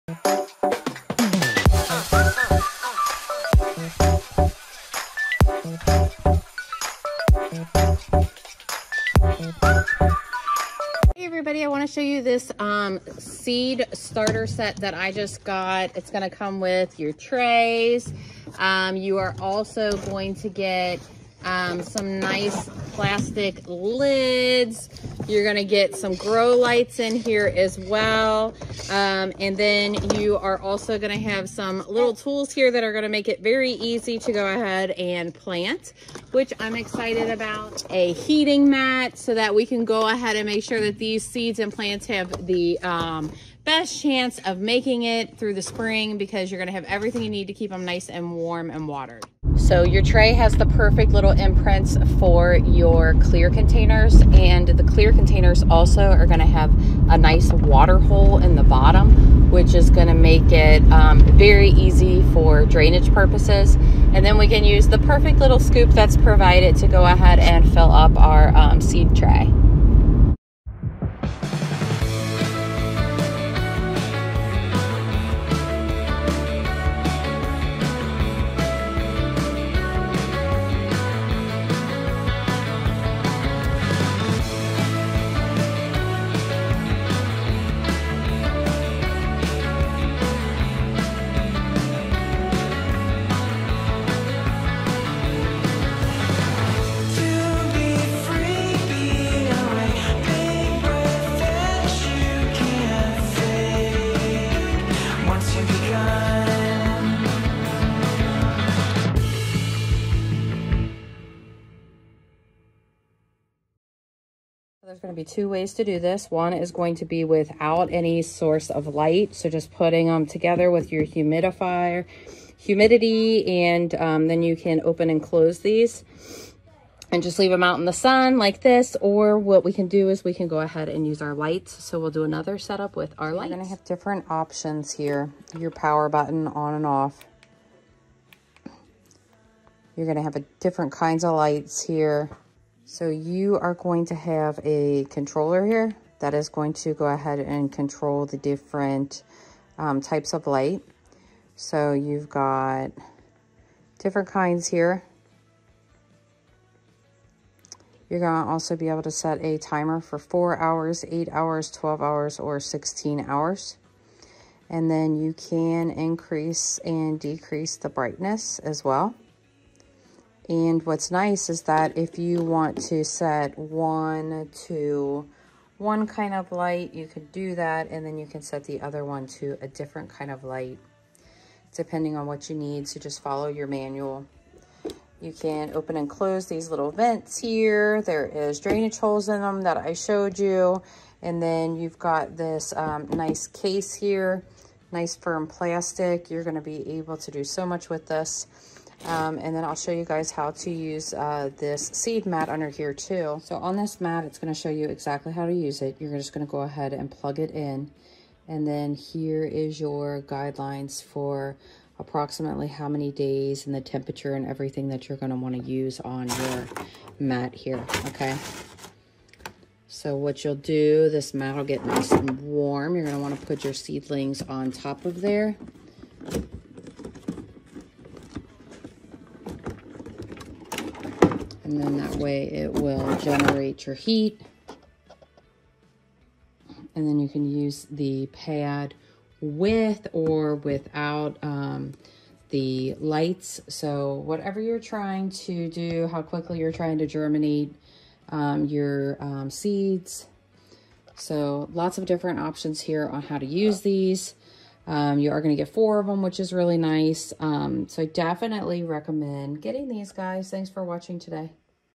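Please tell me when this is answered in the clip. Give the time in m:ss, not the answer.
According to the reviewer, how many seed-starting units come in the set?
4:15.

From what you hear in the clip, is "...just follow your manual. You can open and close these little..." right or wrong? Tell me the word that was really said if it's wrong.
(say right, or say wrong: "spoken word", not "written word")
right.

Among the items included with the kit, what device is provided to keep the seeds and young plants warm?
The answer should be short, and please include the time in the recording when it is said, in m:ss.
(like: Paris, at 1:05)
heating mat, at 0:37.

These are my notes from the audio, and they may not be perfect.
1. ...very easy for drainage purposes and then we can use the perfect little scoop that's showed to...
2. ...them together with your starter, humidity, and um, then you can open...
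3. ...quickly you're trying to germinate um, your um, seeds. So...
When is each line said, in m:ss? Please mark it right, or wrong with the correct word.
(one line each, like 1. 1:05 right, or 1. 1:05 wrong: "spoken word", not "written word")
1. 1:01 wrong: "provided", not "showed"
2. 2:00 wrong: "humidifier", not "starter"
3. 4:06 right.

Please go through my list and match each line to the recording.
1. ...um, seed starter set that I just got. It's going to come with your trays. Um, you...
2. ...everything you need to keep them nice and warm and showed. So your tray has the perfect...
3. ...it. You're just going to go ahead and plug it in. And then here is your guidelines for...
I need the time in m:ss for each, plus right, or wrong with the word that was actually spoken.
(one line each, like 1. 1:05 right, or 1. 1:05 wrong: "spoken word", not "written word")
1. 0:12 right
2. 0:46 wrong: "watered", not "showed"
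3. 3:25 right.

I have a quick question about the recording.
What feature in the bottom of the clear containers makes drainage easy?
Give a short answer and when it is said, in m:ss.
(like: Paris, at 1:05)
water hole, at 0:57.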